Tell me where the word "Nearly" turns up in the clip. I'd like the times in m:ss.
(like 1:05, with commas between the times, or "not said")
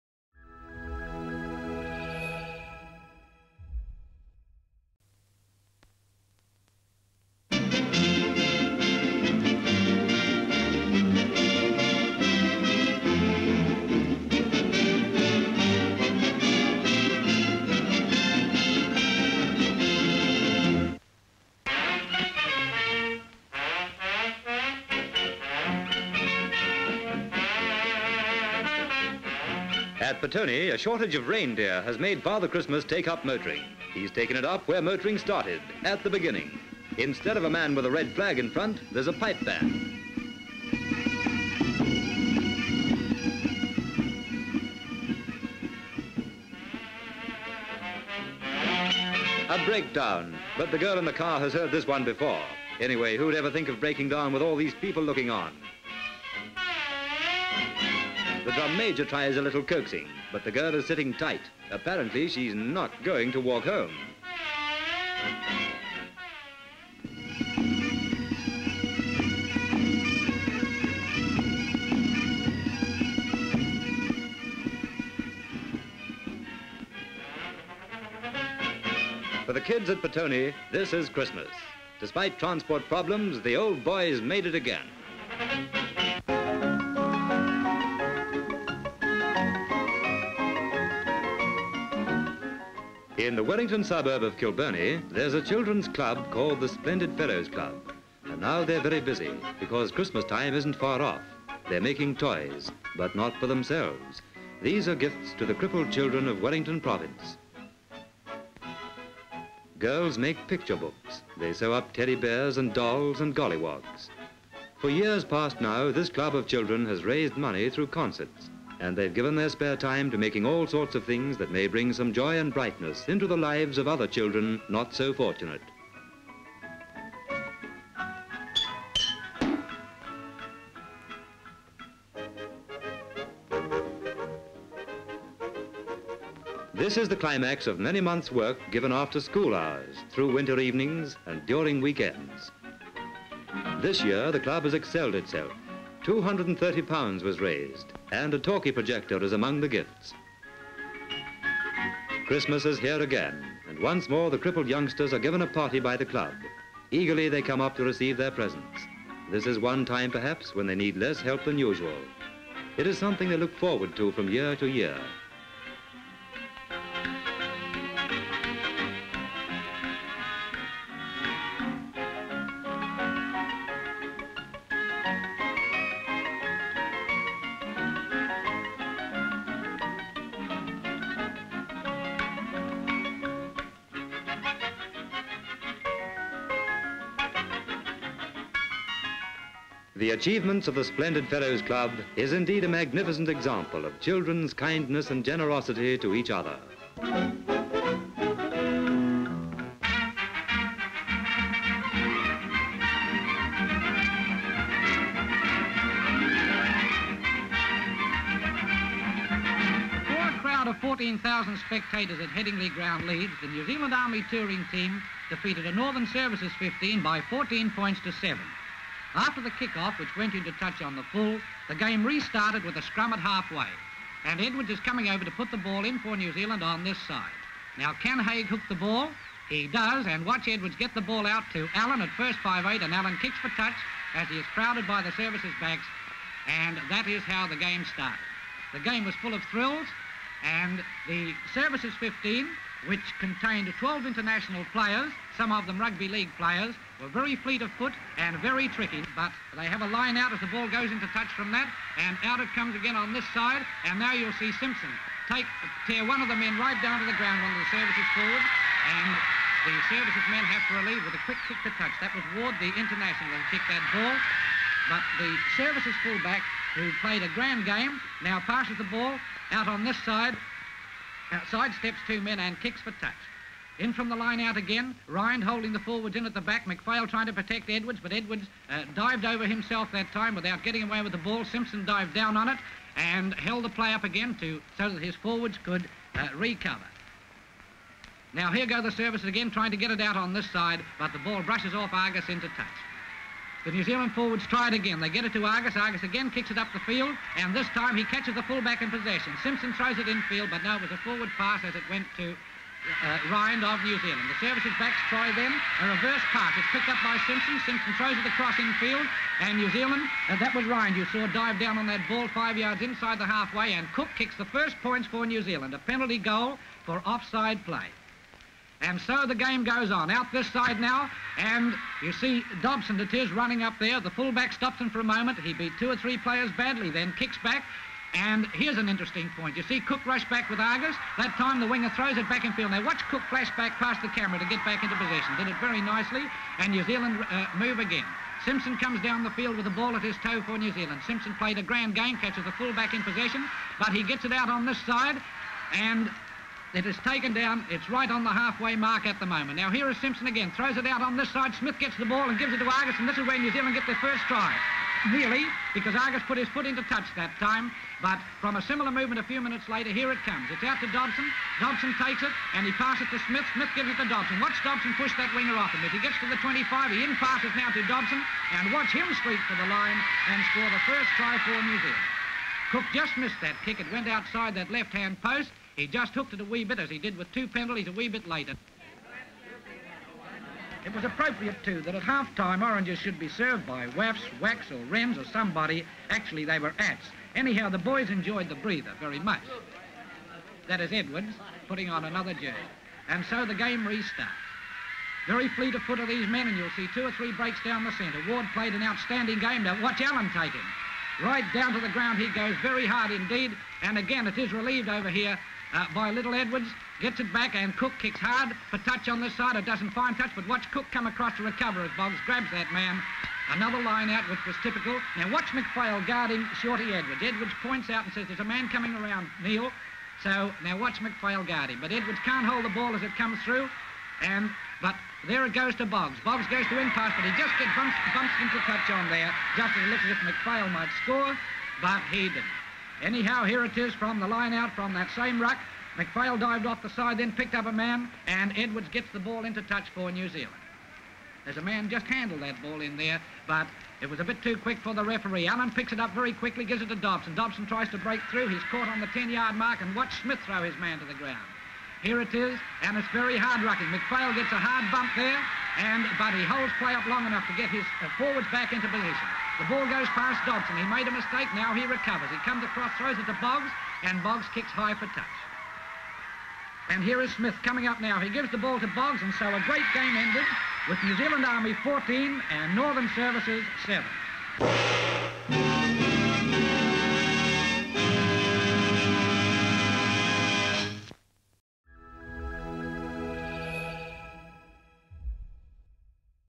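5:55.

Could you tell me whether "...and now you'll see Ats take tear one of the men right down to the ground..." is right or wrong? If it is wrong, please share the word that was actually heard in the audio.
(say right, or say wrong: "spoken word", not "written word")
wrong: "Simpson", not "Ats".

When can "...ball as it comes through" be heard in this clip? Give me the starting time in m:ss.
7:02.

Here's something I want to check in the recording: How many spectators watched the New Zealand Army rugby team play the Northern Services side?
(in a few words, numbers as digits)
14,000.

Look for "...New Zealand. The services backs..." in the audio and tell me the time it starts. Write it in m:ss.
5:03.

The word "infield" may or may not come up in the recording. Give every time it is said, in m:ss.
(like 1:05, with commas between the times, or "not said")
5:00, 5:08.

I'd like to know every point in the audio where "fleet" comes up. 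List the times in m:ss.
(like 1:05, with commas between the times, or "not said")
4:07, 6:35.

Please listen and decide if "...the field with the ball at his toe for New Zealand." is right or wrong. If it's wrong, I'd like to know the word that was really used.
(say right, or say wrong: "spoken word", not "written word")
right.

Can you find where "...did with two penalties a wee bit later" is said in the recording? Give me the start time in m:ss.
6:16.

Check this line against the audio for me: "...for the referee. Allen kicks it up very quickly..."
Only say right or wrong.
wrong.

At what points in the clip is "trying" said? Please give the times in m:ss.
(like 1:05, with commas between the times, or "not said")
4:37, 4:49.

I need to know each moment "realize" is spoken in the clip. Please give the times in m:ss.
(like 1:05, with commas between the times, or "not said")
not said.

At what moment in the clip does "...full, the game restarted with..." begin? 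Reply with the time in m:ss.
3:41.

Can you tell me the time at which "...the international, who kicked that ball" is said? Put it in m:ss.
4:22.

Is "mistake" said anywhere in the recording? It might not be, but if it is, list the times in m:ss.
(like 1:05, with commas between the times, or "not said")
7:41.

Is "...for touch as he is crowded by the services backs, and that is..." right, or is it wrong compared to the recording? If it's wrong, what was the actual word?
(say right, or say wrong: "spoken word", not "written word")
right.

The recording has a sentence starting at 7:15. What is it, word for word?
McPhail dived off the side, then picked up a man, and Edwards gets the ball into touch for New Zealand.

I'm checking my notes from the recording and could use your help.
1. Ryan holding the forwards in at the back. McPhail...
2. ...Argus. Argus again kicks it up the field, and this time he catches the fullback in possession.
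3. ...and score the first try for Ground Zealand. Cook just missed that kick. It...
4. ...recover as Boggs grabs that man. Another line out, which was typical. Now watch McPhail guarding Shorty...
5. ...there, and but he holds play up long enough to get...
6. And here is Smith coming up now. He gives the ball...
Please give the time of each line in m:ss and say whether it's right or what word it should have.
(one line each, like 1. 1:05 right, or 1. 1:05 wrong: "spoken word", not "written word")
1. 4:35 right
2. 4:55 right
3. 6:10 wrong: "New", not "Ground"
4. 6:51 right
5. 7:35 right
6. 7:46 right.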